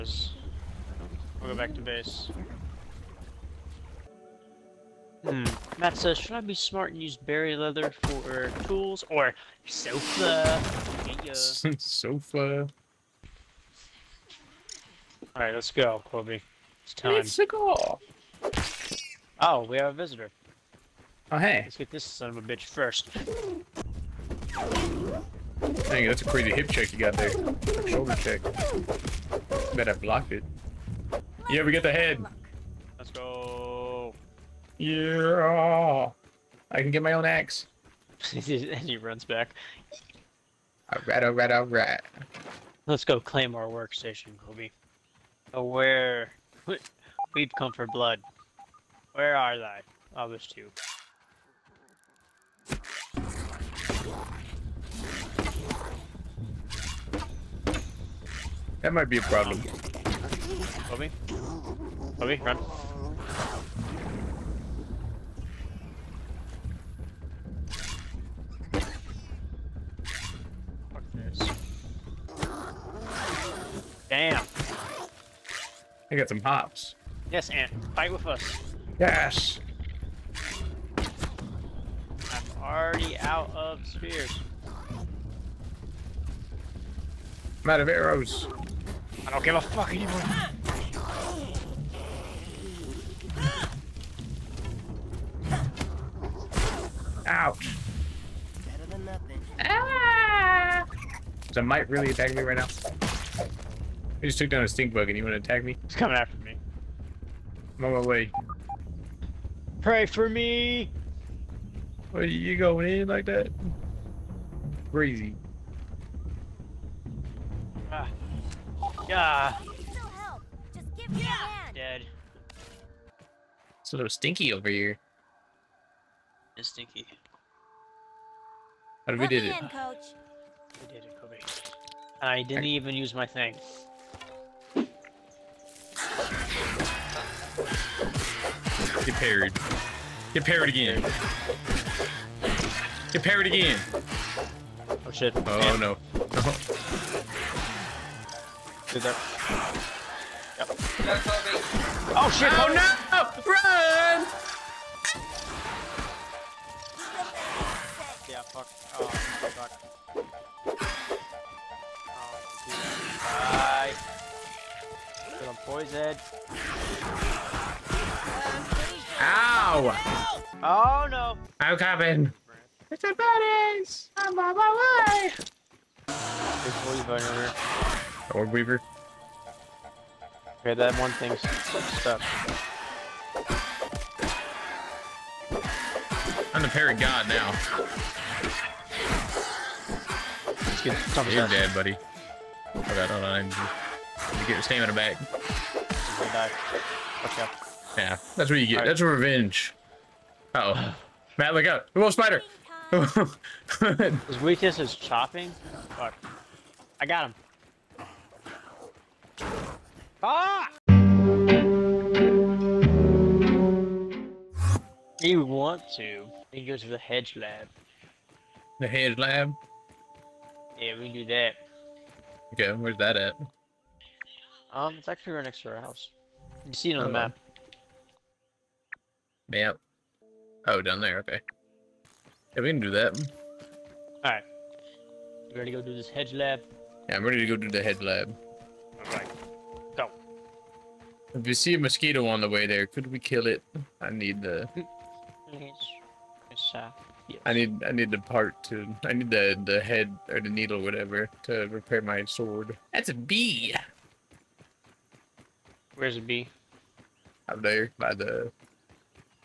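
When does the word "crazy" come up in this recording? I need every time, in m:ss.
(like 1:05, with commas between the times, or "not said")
0:26, 1:54.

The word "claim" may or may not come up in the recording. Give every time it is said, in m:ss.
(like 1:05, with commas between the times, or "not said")
0:43.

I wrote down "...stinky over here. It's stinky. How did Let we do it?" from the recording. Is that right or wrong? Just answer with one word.
right.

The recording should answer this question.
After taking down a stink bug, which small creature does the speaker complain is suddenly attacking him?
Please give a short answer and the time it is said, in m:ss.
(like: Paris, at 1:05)
A mite, at 1:41.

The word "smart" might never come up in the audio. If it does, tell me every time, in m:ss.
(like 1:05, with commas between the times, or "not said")
0:06.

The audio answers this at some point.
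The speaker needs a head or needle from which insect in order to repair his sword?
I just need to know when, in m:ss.
4:01.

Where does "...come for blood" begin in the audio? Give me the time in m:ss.
0:47.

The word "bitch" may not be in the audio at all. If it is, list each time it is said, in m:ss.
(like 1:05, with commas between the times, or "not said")
0:22.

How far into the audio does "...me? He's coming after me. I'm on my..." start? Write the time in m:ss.
1:45.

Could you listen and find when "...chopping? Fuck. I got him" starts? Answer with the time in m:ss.
3:24.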